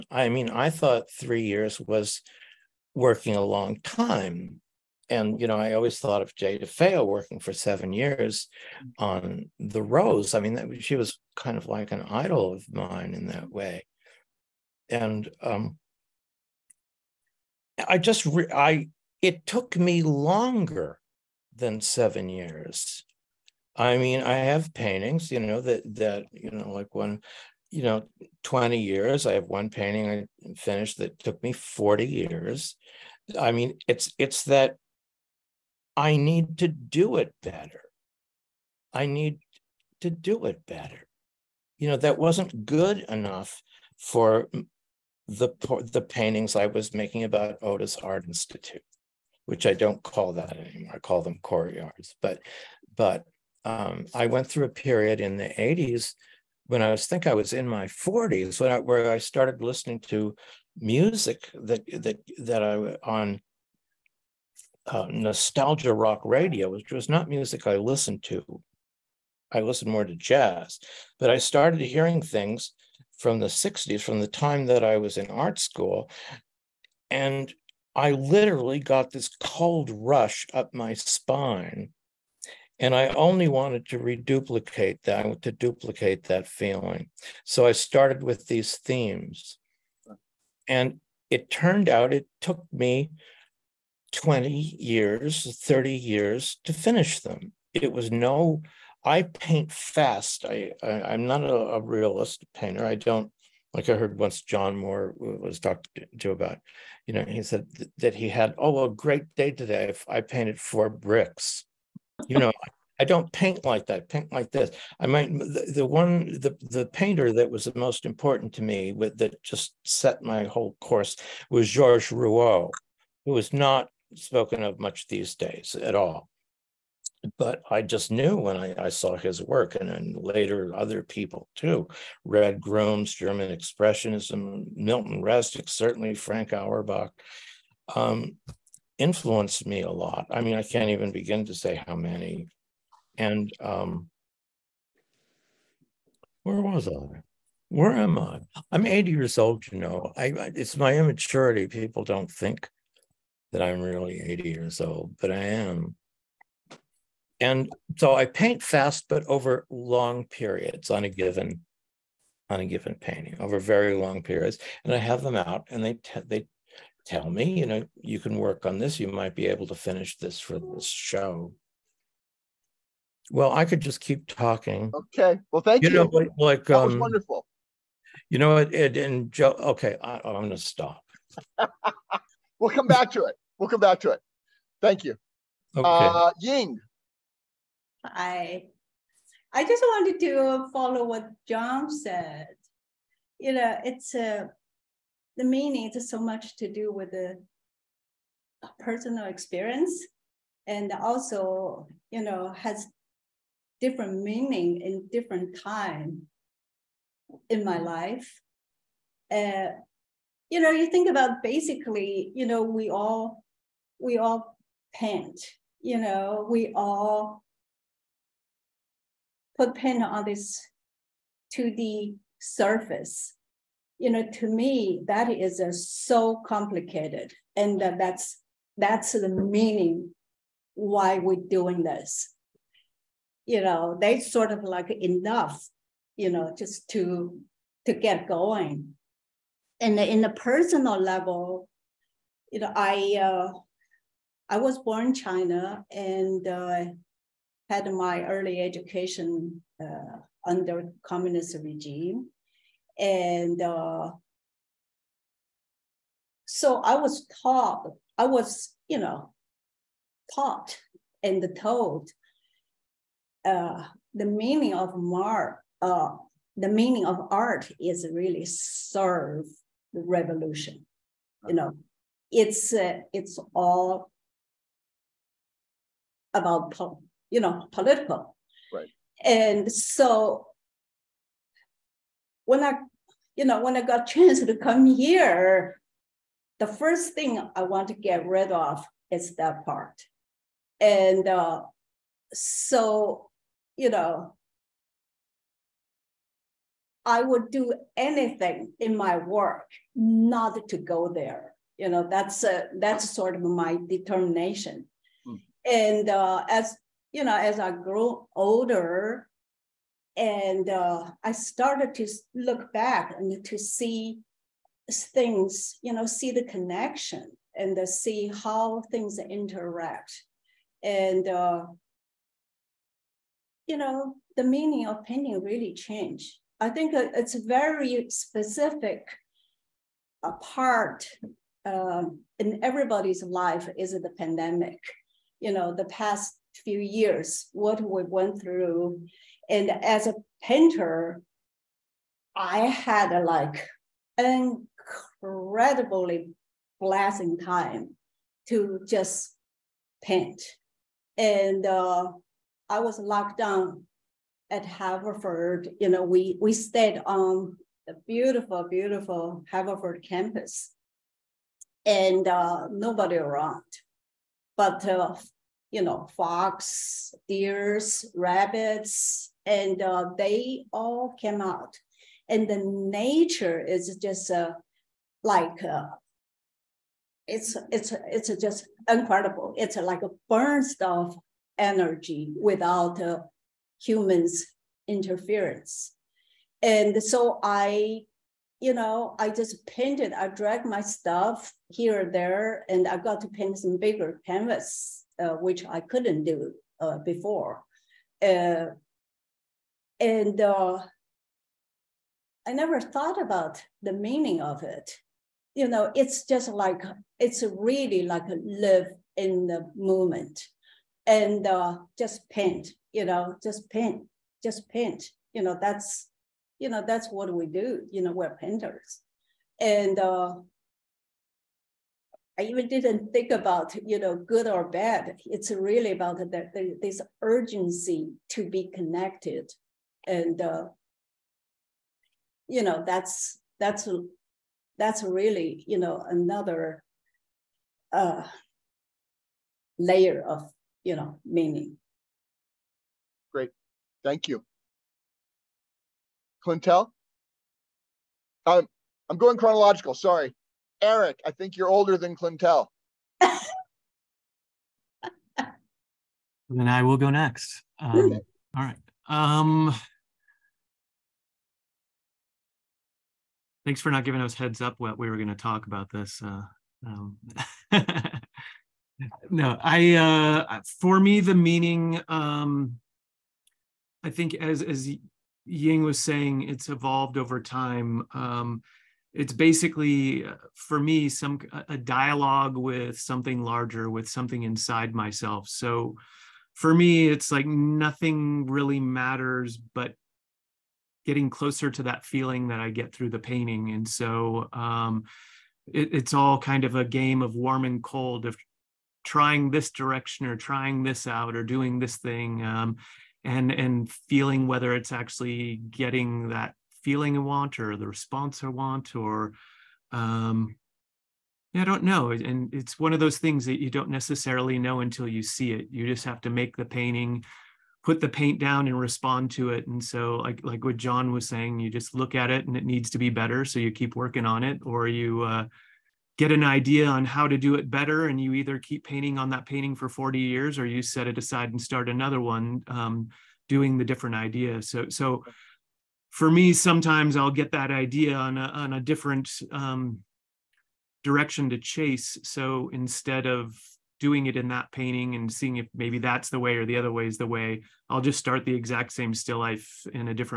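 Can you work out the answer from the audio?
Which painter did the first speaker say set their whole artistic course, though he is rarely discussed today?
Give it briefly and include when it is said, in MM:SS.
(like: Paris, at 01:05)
Georges Rouault, at 02:01.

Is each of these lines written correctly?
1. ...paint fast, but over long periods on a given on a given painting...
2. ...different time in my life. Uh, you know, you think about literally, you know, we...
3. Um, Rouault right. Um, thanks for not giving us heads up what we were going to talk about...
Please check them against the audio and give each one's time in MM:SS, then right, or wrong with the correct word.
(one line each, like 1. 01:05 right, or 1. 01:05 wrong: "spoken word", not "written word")
1. 02:38 right
2. 03:25 wrong: "basically", not "literally"
3. 07:37 wrong: "All", not "Rouault".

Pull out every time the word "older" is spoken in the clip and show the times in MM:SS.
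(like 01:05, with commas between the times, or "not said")
05:08, 07:31.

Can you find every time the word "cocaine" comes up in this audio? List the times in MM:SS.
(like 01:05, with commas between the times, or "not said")
not said.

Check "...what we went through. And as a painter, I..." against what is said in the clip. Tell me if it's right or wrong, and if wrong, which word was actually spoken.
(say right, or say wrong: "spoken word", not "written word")
right.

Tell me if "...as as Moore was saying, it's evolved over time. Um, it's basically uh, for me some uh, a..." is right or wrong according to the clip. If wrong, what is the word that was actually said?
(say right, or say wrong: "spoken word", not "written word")
wrong: "Ying", not "Moore".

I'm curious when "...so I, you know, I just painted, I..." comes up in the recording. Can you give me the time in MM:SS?
06:27.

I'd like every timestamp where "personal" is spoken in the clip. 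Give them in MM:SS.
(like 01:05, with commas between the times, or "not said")
03:18, 04:00.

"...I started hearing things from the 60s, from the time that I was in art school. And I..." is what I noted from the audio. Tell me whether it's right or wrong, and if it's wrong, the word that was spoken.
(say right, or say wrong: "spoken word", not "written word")
right.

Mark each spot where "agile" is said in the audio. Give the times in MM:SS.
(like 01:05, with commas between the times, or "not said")
not said.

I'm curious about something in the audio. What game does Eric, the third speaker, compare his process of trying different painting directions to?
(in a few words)
Warm and cold.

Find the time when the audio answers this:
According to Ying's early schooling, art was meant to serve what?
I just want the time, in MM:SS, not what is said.
04:28.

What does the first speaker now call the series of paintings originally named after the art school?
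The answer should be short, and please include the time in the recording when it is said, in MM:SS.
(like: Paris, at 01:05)
Courtyards, at 00:51.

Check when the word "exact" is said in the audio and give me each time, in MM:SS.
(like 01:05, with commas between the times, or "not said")
09:08.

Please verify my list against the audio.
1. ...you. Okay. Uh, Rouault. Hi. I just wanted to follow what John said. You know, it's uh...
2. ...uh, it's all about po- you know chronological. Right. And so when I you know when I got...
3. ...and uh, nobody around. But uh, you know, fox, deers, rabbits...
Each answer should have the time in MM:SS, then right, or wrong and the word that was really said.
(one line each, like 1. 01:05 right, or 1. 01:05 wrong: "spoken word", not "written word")
1. 03:05 wrong: "Ying", not "Rouault"
2. 04:32 wrong: "political", not "chronological"
3. 06:01 right.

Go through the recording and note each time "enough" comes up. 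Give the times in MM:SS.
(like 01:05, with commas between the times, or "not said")
00:43, 03:54.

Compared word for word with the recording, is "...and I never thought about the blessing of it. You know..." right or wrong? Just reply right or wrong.
wrong.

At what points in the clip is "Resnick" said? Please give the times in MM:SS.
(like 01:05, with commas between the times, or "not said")
02:15.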